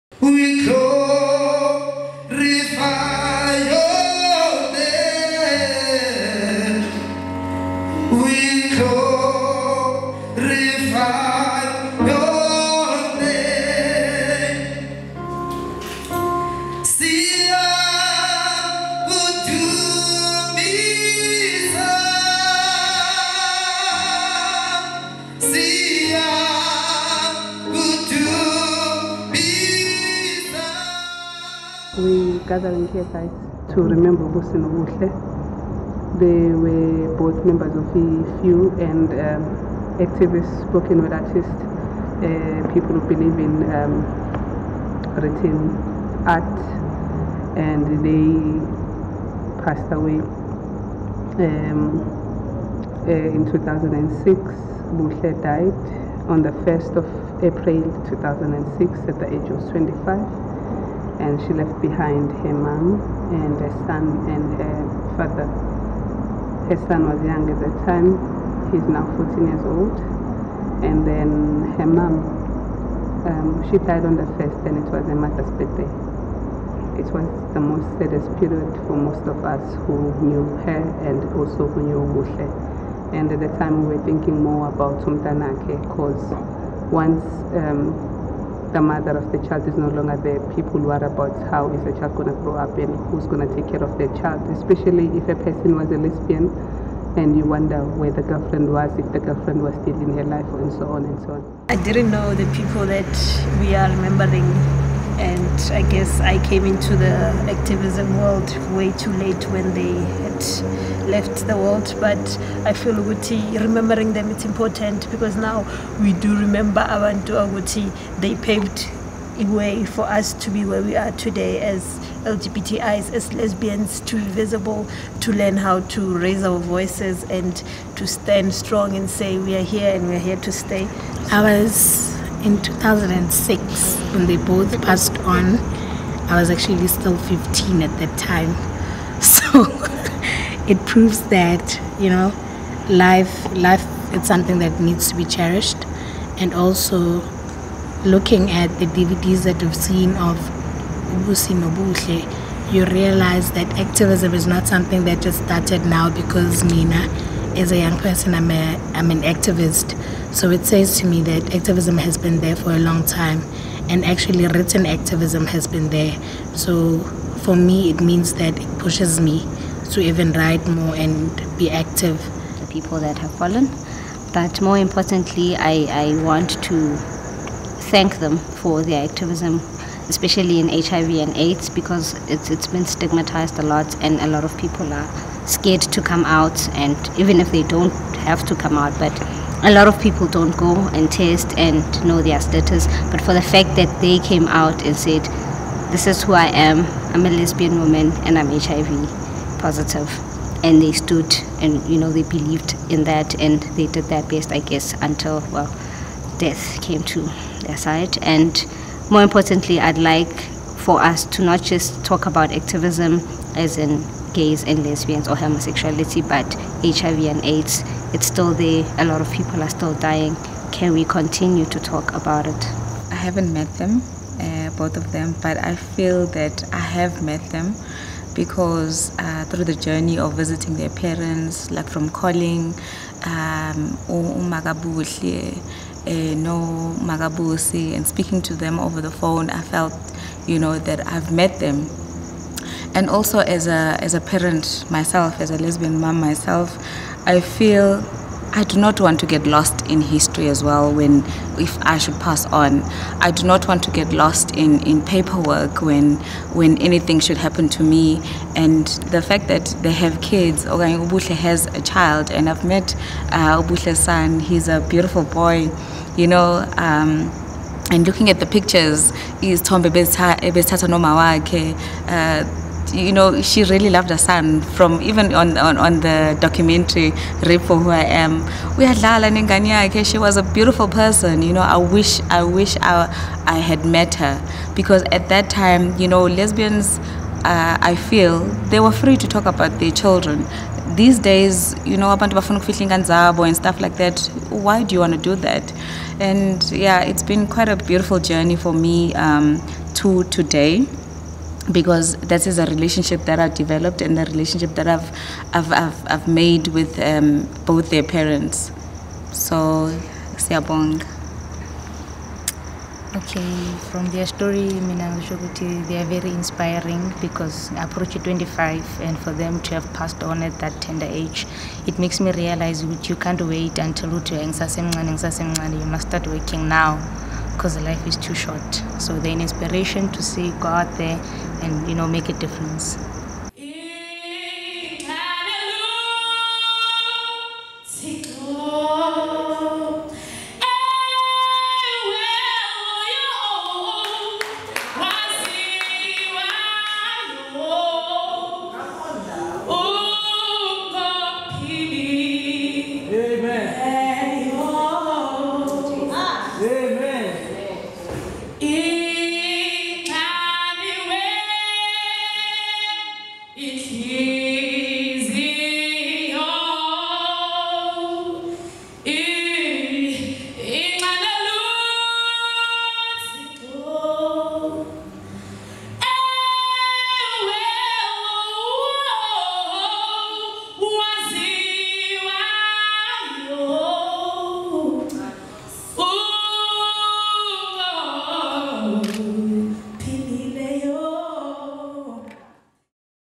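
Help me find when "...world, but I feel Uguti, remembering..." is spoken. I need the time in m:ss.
1:51.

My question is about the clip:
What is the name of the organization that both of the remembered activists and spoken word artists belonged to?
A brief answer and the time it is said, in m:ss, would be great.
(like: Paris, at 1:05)
FEW, at 0:37.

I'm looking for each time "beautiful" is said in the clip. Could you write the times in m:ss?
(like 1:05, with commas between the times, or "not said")
4:24, 4:40, 4:57.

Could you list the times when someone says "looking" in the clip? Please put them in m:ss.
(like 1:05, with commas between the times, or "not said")
2:28, 4:28.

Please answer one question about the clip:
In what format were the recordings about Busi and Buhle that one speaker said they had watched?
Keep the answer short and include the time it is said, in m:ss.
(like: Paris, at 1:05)
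DVDs, at 2:28.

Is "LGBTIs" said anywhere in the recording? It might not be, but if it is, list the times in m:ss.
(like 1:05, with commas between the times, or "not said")
2:02.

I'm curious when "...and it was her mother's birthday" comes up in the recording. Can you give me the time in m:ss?
1:14.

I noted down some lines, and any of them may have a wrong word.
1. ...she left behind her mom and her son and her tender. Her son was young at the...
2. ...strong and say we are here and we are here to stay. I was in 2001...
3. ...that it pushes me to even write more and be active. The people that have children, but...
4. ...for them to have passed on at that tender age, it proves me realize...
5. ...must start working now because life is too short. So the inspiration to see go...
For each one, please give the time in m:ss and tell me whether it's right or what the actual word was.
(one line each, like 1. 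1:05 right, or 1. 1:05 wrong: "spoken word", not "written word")
1. 1:01 wrong: "father", not "tender"
2. 2:08 wrong: "2006", not "2001"
3. 2:48 wrong: "fallen", not "children"
4. 5:19 wrong: "makes", not "proves"
5. 5:25 right.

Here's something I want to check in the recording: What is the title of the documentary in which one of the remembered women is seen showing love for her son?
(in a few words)
Rape for Who I Am.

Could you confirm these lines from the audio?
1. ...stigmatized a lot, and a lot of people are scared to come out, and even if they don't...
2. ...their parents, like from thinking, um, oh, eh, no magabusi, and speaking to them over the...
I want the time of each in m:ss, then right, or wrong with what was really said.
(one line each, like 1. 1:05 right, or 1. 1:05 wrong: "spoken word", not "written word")
1. 3:02 right
2. 3:50 wrong: "calling", not "thinking".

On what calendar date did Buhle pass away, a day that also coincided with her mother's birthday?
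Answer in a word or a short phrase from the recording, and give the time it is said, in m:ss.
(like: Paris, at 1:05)
1 April, at 0:56.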